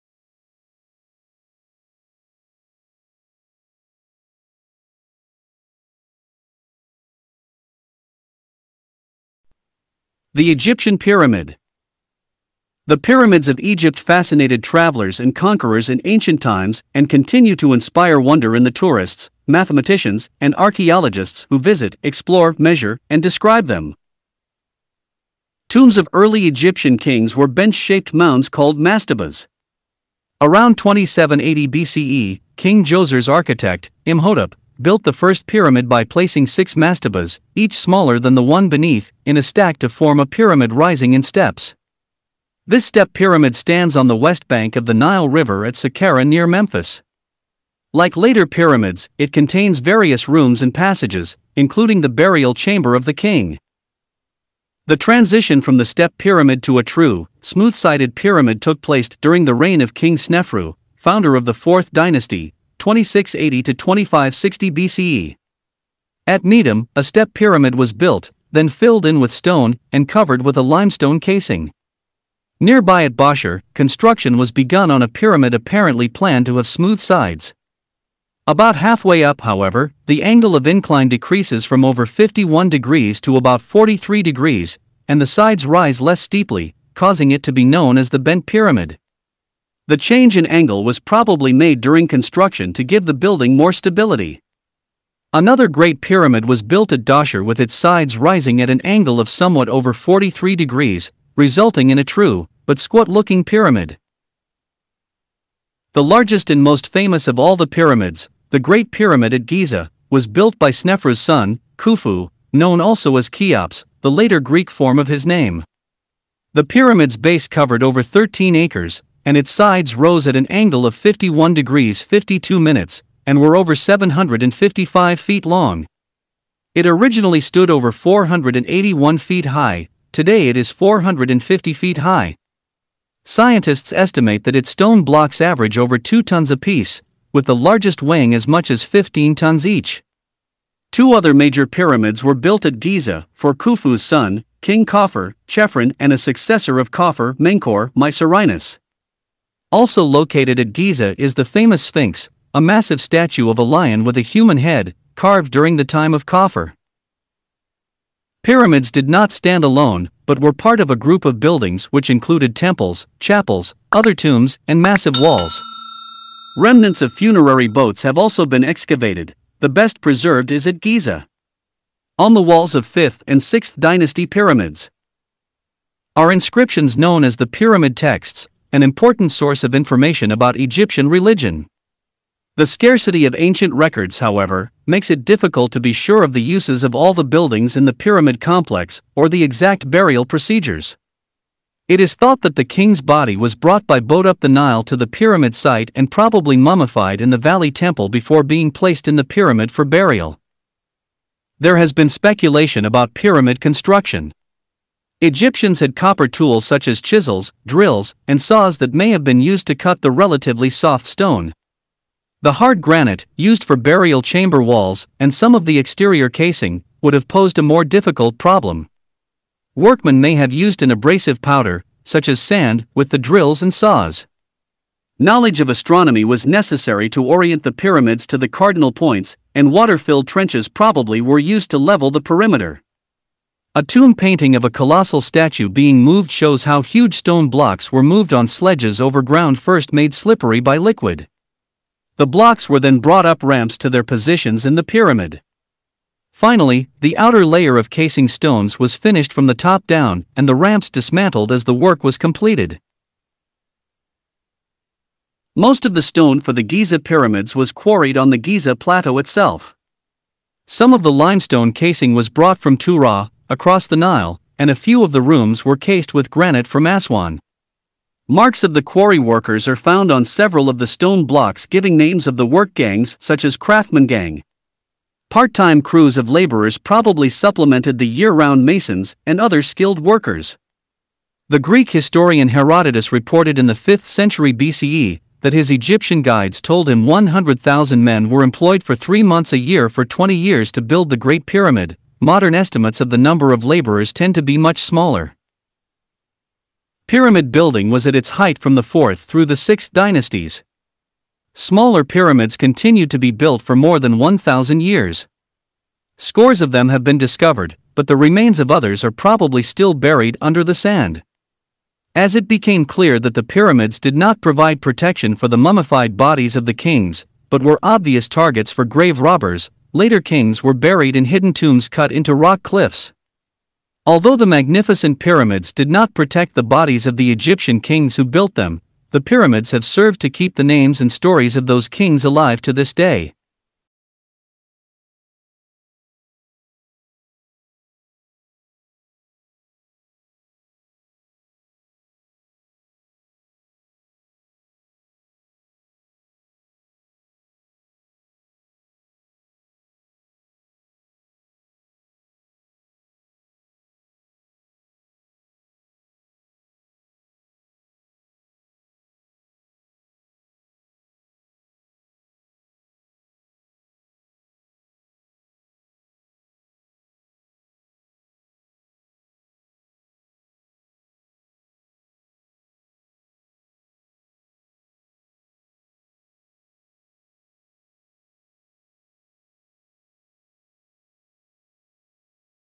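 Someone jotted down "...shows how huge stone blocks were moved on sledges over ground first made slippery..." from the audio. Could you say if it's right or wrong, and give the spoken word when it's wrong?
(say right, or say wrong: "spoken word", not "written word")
right.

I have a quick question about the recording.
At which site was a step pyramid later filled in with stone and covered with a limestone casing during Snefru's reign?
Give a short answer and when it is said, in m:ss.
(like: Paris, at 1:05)
Maidum, at 1:06.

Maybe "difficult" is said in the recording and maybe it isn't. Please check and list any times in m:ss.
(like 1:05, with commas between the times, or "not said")
3:05, 3:37.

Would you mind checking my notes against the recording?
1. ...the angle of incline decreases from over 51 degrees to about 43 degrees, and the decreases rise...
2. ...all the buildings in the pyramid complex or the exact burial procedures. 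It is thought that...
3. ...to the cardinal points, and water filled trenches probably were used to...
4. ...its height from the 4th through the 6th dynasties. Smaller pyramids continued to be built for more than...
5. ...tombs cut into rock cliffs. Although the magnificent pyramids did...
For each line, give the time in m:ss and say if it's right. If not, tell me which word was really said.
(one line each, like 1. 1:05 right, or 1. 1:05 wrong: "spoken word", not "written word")
1. 1:20 wrong: "sides", not "decreases"
2. 3:06 right
3. 3:48 right
4. 4:58 right
5. 5:21 right.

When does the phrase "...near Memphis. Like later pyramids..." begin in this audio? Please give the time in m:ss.
0:46.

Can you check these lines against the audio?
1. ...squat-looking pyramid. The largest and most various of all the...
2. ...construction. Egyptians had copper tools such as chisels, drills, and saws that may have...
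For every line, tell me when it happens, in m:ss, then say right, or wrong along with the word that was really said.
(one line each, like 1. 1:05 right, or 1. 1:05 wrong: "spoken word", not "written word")
1. 1:42 wrong: "famous", not "various"
2. 3:23 right.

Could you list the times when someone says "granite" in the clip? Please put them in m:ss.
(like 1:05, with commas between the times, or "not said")
3:32, 4:26.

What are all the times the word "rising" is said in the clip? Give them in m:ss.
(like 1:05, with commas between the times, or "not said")
0:40, 1:38.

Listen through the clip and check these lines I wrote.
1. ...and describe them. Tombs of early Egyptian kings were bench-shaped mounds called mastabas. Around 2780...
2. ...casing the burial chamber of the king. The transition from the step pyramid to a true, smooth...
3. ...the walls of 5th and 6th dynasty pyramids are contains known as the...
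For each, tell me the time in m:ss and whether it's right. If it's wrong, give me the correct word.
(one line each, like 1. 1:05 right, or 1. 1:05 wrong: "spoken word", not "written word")
1. 0:23 right
2. 0:51 wrong: "including", not "casing"
3. 2:52 wrong: "inscriptions", not "contains".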